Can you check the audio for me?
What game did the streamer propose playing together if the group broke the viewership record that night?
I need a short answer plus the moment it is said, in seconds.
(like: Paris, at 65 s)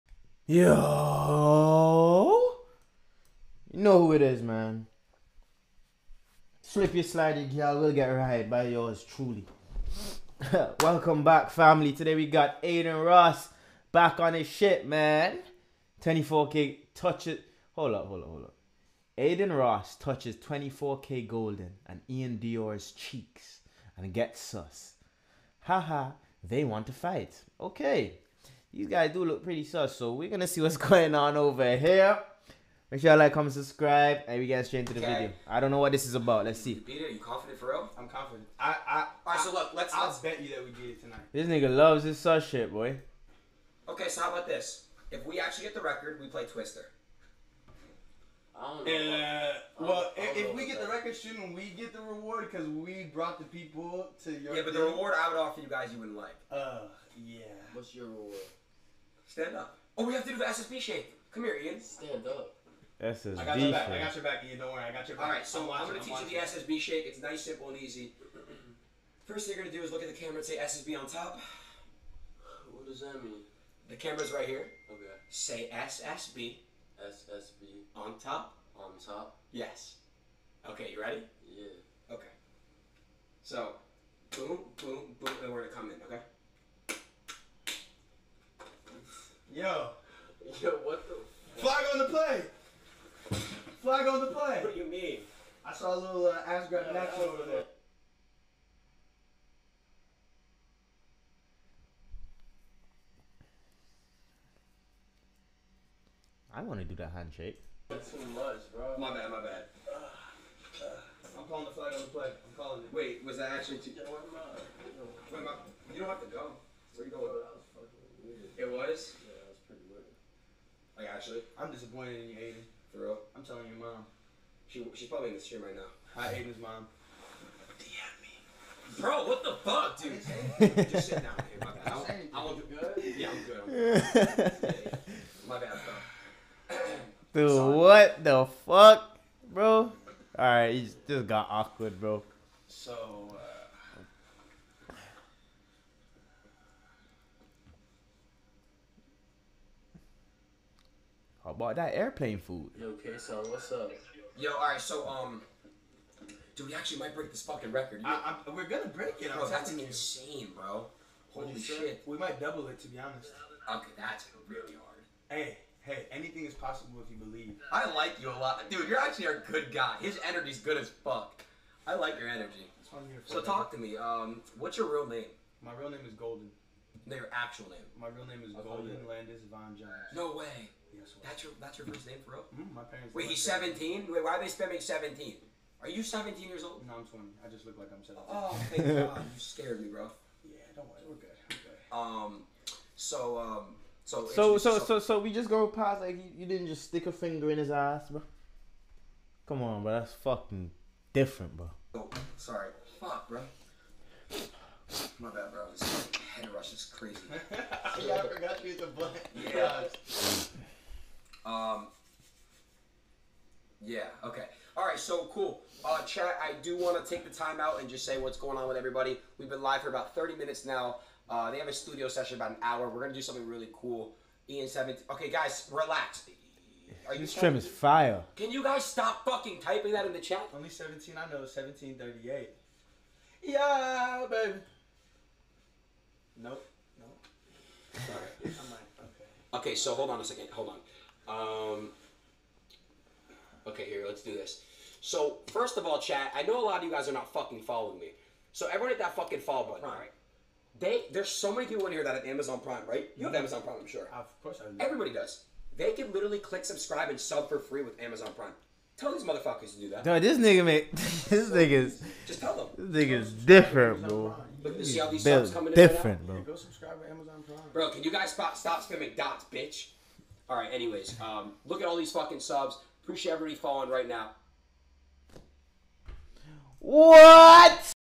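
Twister, at 46 s.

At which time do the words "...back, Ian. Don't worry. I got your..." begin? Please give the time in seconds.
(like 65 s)
64 s.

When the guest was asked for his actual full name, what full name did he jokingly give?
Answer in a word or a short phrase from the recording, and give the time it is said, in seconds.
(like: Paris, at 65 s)
Golden Landis Von Jones, at 178 s.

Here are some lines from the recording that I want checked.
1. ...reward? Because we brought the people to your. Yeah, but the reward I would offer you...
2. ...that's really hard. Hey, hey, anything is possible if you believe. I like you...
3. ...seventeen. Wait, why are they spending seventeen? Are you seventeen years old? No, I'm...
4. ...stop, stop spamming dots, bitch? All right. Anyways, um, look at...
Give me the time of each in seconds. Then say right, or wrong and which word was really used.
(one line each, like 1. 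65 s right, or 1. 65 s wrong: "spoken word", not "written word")
1. 52 s right
2. 163 s right
3. 183 s right
4. 268 s right.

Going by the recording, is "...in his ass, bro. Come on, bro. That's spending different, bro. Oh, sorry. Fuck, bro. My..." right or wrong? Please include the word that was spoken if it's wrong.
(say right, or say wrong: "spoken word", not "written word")
wrong: "fucking", not "spending".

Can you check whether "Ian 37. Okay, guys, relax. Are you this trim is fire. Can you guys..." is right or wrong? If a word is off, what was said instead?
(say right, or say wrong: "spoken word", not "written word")
wrong: "17", not "37".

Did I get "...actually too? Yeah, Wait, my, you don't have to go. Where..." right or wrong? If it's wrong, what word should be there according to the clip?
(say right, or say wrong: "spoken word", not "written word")
right.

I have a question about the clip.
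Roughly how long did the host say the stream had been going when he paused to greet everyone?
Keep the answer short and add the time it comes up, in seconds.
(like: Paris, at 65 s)
30 minutes, at 220 s.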